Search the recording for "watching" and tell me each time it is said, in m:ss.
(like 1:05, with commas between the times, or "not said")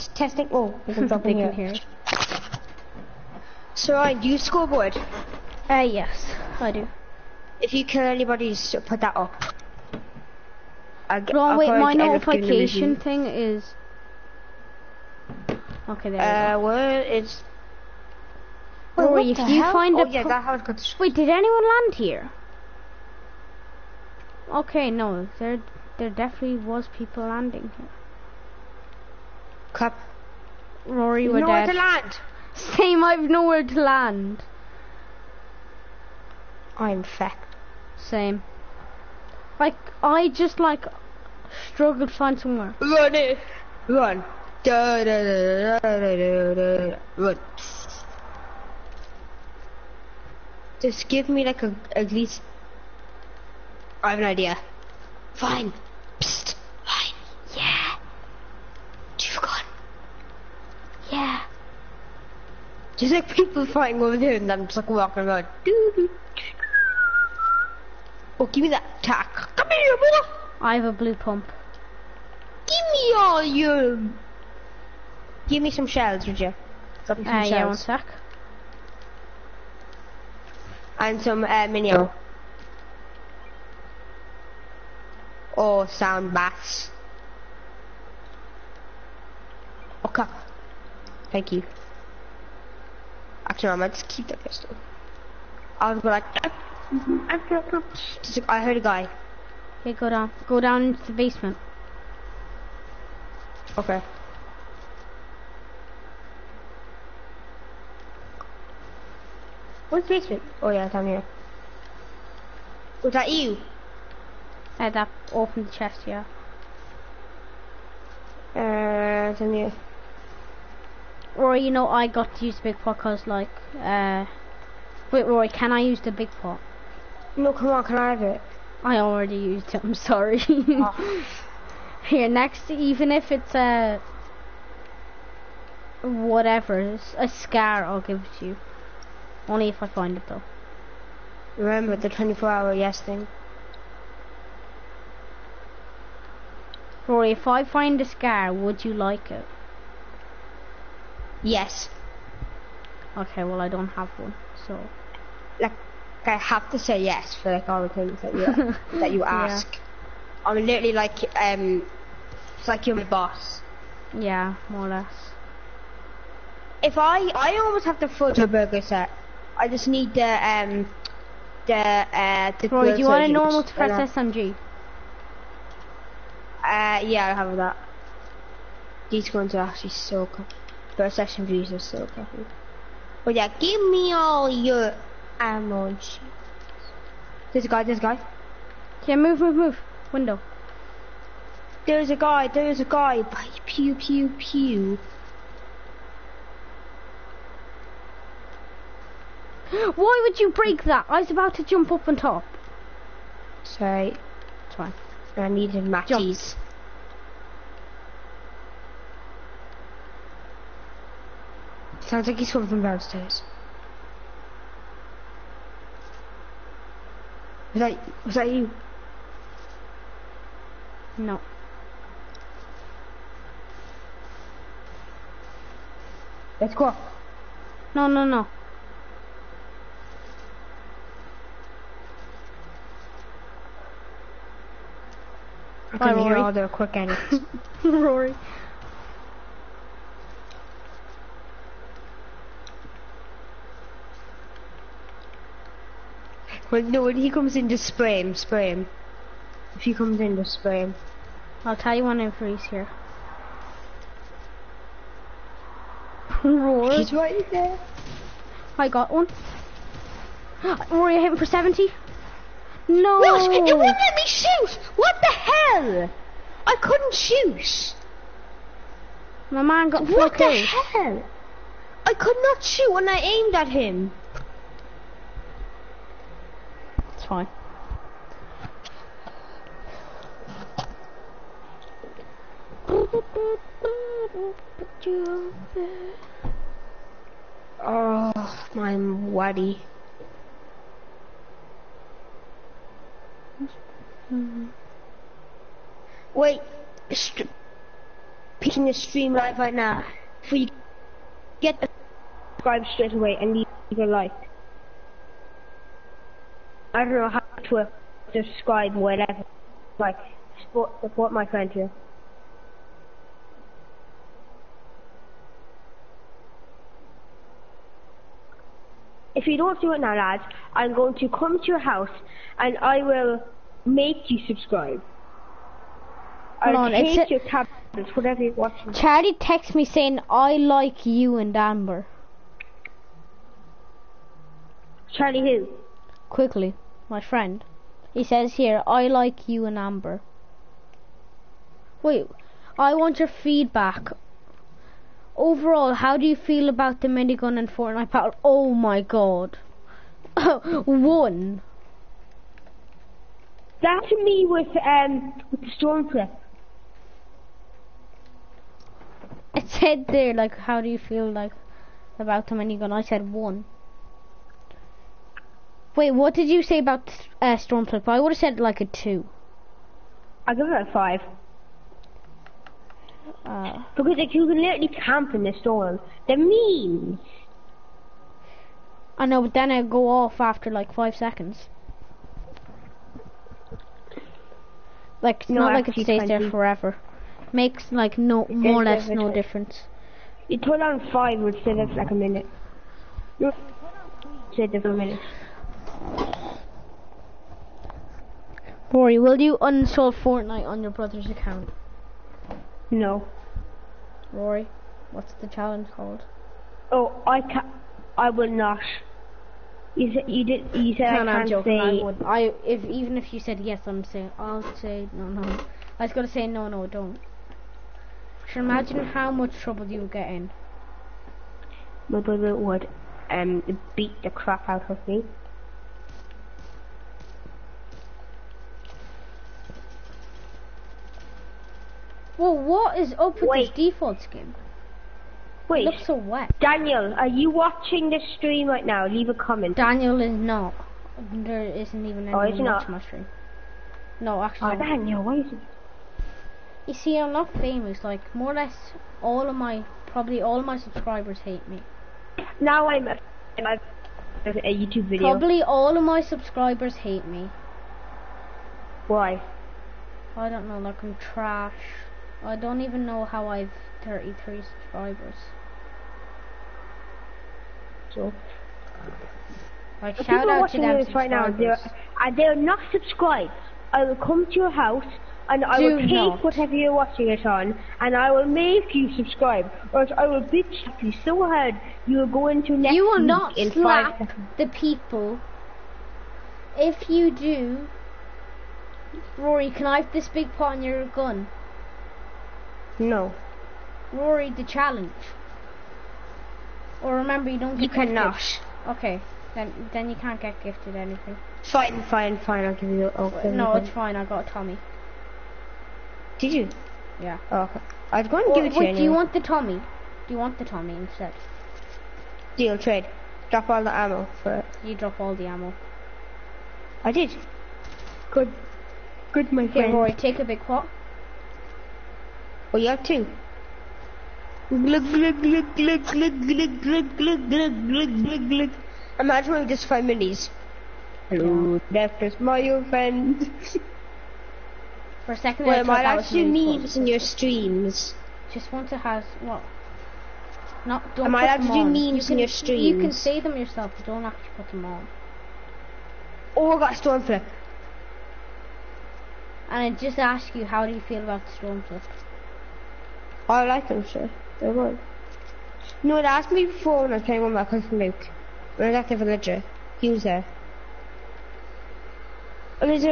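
5:28, 7:17, 7:22, 7:50, 7:56.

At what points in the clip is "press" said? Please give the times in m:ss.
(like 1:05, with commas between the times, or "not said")
2:53.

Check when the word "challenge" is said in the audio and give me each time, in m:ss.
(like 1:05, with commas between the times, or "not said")
6:45, 8:14.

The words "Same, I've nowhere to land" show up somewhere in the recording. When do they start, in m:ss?
0:32.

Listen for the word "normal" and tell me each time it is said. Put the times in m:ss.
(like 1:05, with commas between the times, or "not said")
2:53.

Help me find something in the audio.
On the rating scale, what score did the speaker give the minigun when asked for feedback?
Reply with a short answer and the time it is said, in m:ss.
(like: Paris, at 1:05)
1, at 6:02.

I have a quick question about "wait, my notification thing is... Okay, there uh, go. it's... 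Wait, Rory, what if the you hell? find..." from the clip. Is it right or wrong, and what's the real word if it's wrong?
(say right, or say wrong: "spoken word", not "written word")
right.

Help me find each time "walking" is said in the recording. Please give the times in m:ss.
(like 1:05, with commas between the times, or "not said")
1:04.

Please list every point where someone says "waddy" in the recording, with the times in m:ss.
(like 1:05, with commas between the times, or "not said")
4:48.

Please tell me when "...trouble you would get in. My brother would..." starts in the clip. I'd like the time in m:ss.
6:59.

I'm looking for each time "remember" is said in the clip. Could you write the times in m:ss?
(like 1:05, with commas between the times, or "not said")
2:21, 8:17.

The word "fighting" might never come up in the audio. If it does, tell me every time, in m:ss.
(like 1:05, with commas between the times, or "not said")
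1:03.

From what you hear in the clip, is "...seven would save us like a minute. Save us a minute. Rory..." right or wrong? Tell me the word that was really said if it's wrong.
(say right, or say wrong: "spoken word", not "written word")
wrong: "five", not "seven".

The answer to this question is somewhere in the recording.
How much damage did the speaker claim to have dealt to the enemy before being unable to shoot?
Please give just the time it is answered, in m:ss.
4:21.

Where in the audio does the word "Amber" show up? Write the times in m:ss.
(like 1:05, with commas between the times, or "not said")
5:31, 5:39.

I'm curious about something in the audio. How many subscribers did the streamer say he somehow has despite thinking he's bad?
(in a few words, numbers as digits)
33.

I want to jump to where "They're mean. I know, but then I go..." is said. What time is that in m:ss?
6:16.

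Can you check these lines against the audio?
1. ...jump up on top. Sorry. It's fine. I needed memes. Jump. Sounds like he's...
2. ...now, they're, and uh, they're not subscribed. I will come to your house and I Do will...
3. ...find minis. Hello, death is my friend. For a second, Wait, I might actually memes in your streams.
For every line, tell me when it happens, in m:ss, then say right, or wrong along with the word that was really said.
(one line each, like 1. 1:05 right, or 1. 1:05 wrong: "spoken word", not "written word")
1. 3:21 wrong: "matches", not "memes"
2. 7:51 right
3. 8:49 right.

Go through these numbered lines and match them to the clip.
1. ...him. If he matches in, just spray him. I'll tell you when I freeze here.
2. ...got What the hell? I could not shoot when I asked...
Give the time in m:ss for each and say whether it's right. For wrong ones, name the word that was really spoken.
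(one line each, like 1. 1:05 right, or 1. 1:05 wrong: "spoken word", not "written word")
1. 4:08 wrong: "comes", not "matches"
2. 4:29 wrong: "aimed", not "asked".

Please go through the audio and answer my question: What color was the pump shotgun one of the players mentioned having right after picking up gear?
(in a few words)
Blue.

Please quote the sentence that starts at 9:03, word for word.
You don't actually put them on.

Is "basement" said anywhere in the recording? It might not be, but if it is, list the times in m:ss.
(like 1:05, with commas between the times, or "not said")
1:41, 1:50.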